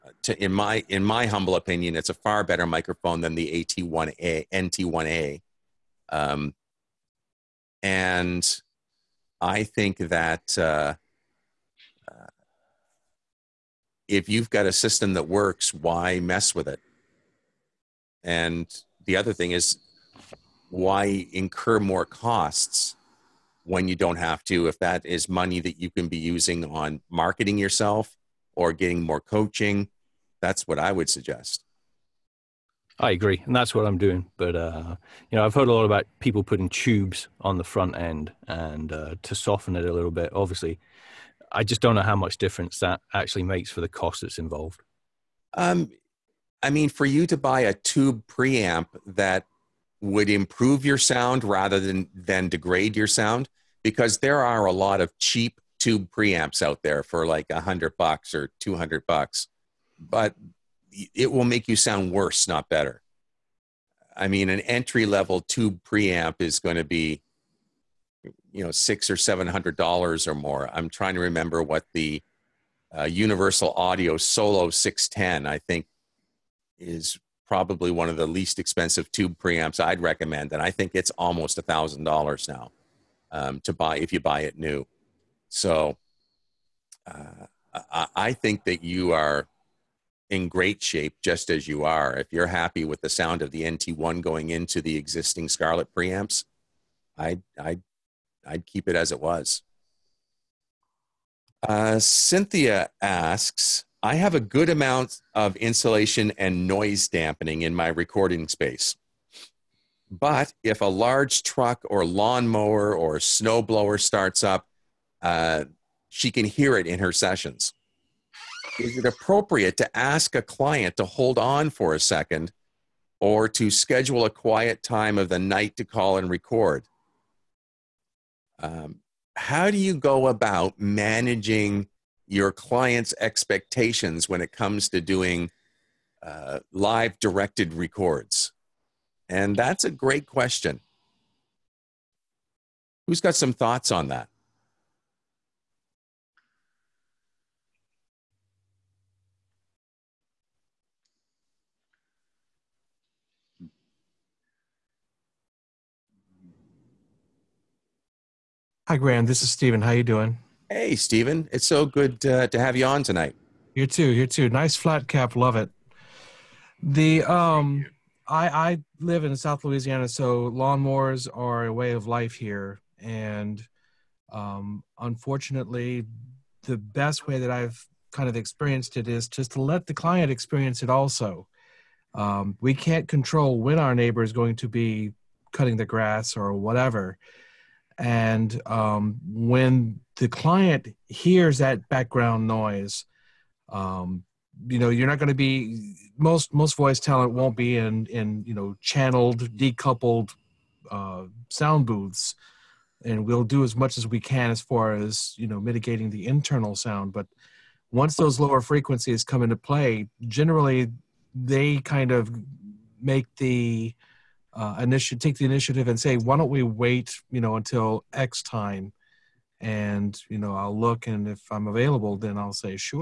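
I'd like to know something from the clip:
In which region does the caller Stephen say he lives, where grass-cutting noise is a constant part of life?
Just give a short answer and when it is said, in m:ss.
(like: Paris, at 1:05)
South Louisiana, at 2:49.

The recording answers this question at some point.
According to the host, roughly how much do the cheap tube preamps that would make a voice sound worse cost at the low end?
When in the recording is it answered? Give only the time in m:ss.
0:57.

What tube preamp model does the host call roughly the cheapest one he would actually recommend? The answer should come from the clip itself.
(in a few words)
Universal Audio Solo 610.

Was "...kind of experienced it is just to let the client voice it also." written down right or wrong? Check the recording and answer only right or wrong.
wrong.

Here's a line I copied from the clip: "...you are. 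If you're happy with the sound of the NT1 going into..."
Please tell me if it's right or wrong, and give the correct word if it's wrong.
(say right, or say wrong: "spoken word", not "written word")
right.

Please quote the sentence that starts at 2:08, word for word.
Um, how do you go about managing your client's expectations when it comes to doing uh, live directed records?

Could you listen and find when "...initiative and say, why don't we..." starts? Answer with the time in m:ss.
3:35.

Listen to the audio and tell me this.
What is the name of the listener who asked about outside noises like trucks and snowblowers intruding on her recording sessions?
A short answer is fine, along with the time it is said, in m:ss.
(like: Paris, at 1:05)
Cynthia, at 1:41.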